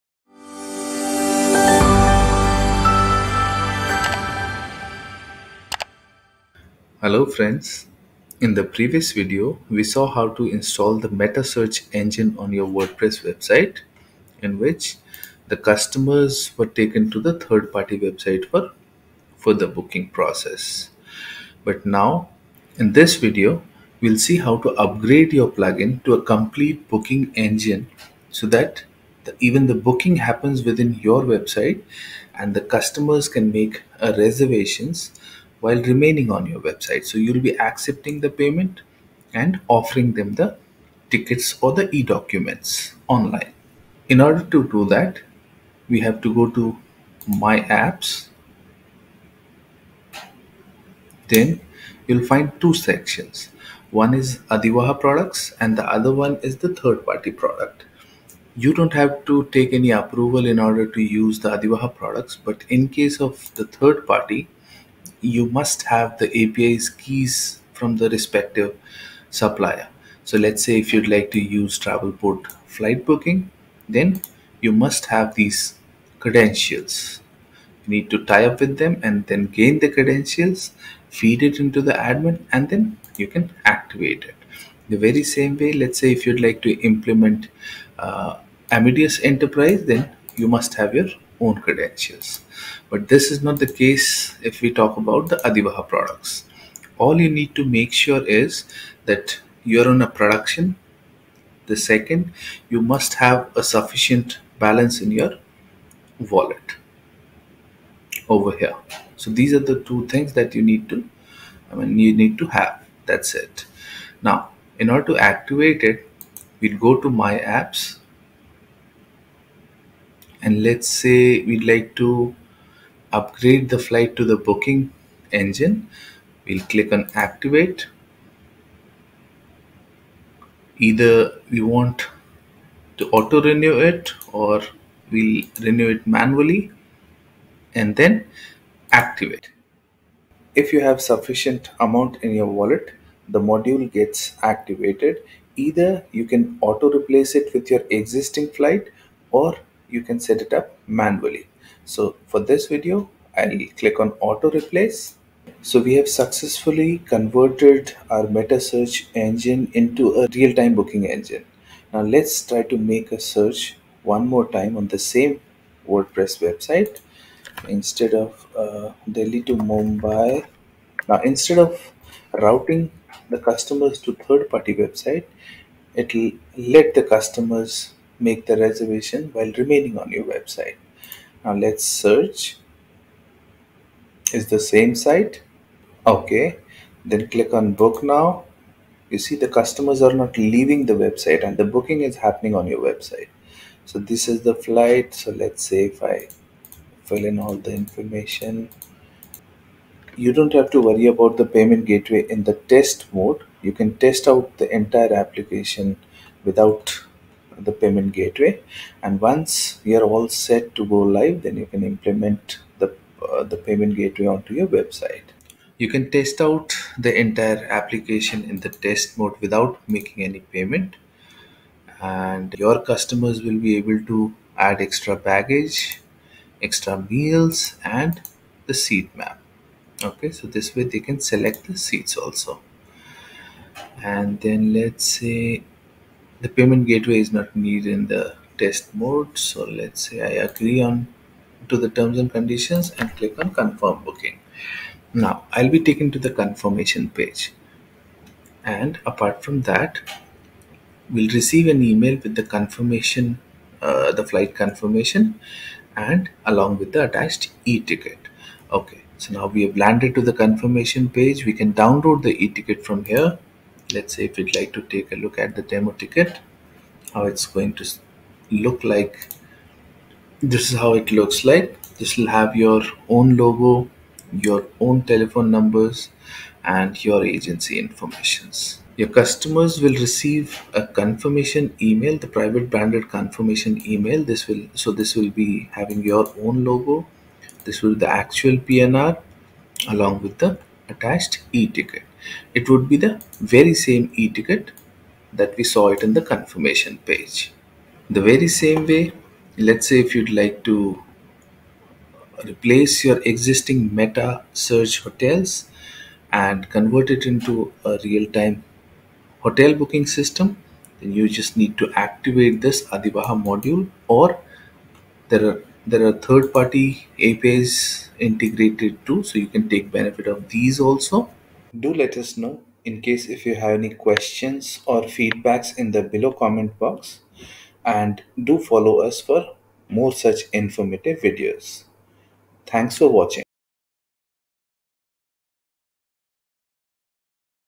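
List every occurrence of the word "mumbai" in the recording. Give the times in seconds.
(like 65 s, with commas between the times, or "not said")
169 s.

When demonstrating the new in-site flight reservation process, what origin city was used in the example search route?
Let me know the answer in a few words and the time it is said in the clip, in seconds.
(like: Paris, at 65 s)
Delhi, at 169 s.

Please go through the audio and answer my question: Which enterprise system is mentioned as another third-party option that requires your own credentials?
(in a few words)
Amadeus Enterprise.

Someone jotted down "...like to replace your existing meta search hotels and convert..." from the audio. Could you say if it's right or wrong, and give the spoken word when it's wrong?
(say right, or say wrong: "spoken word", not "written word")
right.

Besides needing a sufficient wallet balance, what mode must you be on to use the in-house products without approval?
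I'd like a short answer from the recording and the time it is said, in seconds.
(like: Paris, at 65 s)
production, at 100 s.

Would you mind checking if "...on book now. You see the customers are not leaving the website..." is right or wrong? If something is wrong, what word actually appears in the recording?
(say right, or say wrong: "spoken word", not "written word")
right.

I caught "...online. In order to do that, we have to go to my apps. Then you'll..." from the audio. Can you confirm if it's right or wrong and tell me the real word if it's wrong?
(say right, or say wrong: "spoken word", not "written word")
right.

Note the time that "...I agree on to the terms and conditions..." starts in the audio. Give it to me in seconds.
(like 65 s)
240 s.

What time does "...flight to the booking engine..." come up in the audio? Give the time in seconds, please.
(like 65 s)
123 s.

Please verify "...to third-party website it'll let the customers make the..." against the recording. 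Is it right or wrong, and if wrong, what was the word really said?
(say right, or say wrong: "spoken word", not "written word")
right.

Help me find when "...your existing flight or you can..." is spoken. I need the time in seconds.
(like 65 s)
147 s.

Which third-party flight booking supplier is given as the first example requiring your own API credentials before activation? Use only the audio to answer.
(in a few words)
Travelport.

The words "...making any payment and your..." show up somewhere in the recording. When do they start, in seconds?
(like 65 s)
219 s.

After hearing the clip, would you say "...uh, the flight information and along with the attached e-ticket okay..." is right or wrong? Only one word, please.
wrong.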